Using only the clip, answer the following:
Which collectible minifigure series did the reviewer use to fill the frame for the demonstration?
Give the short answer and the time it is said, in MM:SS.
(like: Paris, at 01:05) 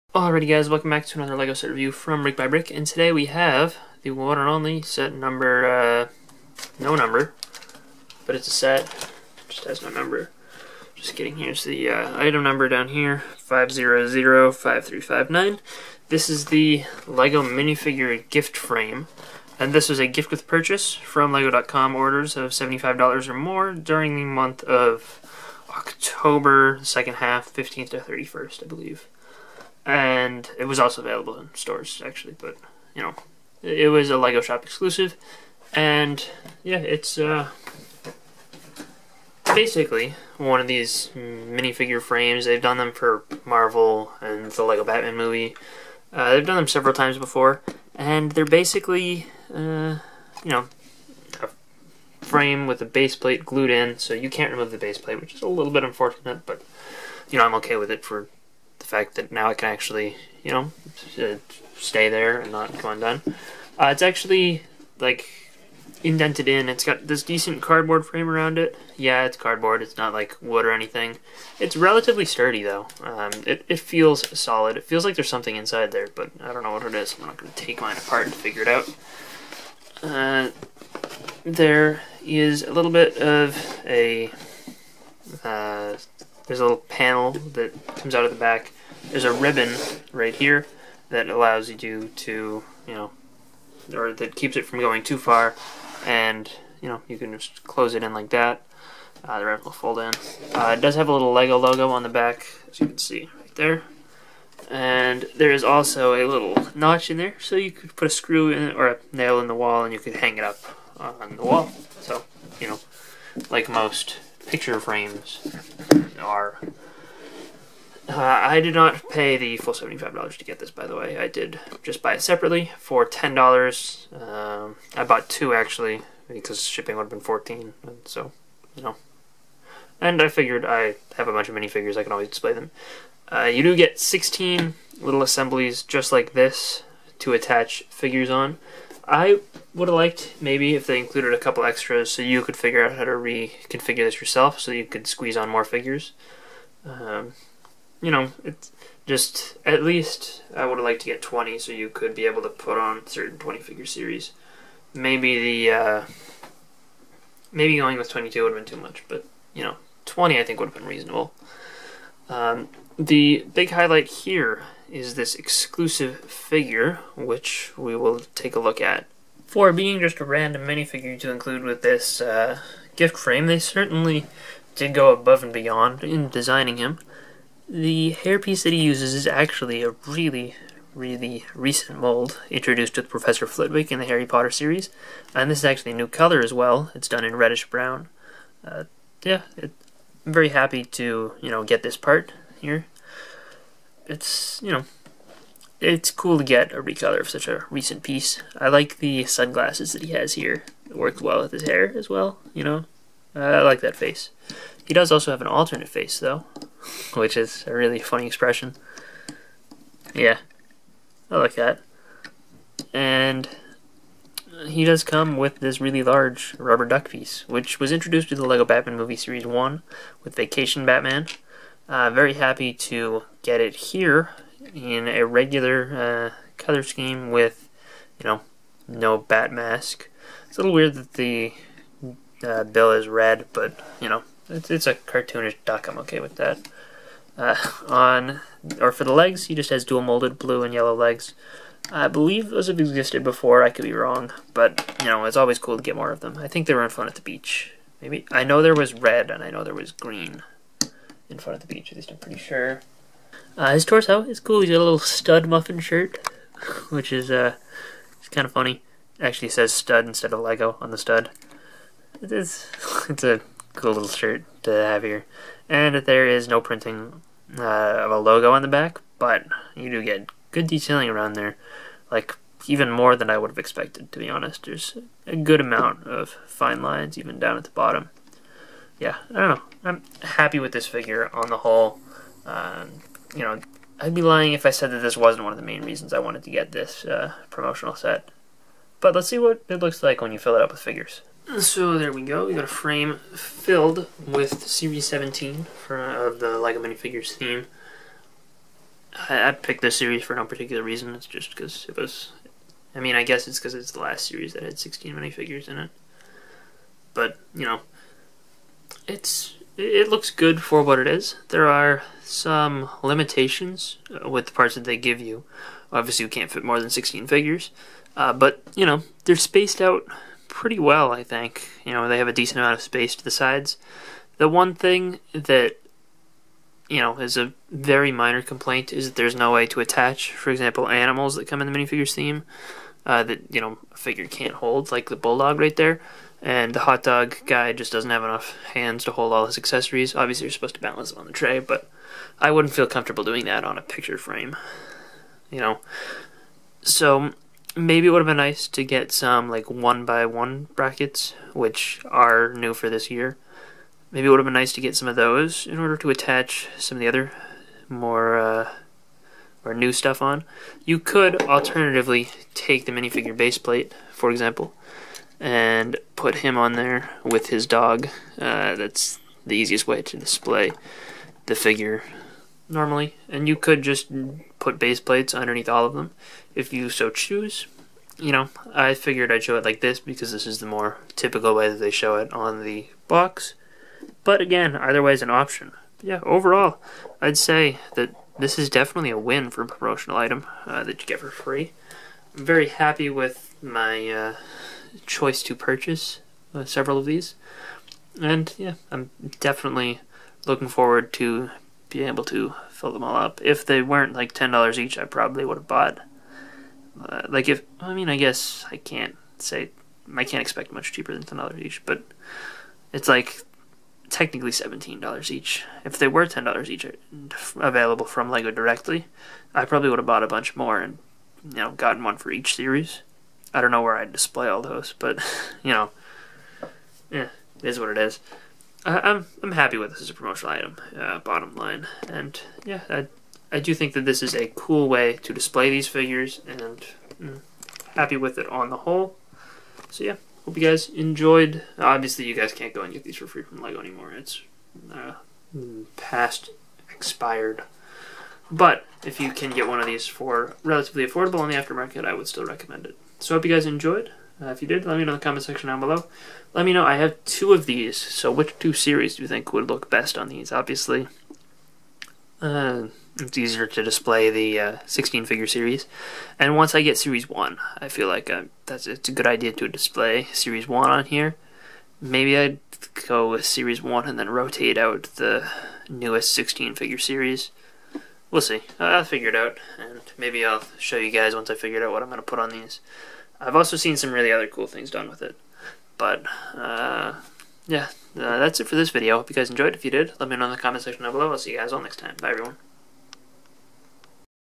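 Series 17, at 04:54.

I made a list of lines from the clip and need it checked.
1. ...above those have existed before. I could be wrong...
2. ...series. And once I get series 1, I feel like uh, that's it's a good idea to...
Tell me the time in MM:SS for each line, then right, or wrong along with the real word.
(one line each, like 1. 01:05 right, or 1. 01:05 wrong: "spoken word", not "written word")
1. 04:02 wrong: "believe", not "above"
2. 07:45 right.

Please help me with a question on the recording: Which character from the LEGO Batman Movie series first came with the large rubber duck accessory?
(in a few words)
Vacation Batman.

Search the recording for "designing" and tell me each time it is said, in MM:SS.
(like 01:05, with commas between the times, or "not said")
02:56.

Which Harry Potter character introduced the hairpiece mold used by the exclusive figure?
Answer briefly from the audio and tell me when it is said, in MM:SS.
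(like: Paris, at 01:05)
Professor Flitwick, at 03:03.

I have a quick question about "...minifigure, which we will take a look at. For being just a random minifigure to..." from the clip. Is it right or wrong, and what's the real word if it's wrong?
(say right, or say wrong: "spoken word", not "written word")
wrong: "figure", not "minifigure".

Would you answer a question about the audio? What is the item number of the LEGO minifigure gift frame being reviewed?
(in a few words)
5005359.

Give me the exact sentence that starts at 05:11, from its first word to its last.
There are some limitations uh, with the parts that they give you.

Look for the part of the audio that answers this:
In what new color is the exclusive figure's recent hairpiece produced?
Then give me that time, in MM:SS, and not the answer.
03:07.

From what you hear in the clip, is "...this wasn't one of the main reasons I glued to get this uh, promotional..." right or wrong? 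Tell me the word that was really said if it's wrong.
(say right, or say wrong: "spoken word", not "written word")
wrong: "wanted", not "glued".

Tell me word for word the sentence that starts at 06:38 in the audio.
And yeah, I'm definitely looking forward to being able to fill them all up.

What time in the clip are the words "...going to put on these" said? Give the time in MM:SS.
08:02.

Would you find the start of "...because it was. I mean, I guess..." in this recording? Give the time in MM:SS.
05:01.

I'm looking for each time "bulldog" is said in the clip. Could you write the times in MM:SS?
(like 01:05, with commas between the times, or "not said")
05:35.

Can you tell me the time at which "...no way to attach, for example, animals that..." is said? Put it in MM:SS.
05:29.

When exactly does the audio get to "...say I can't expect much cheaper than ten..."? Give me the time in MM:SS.
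06:49.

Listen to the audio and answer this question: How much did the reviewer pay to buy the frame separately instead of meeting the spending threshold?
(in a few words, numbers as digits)
$10.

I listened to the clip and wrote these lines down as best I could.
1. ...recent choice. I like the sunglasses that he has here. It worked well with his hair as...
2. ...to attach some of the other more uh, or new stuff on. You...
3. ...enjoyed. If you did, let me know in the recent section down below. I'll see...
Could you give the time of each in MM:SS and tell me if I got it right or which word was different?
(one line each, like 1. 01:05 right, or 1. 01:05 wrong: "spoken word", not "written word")
1. 03:17 wrong: "piece", not "choice"
2. 05:55 right
3. 08:09 wrong: "comment", not "recent".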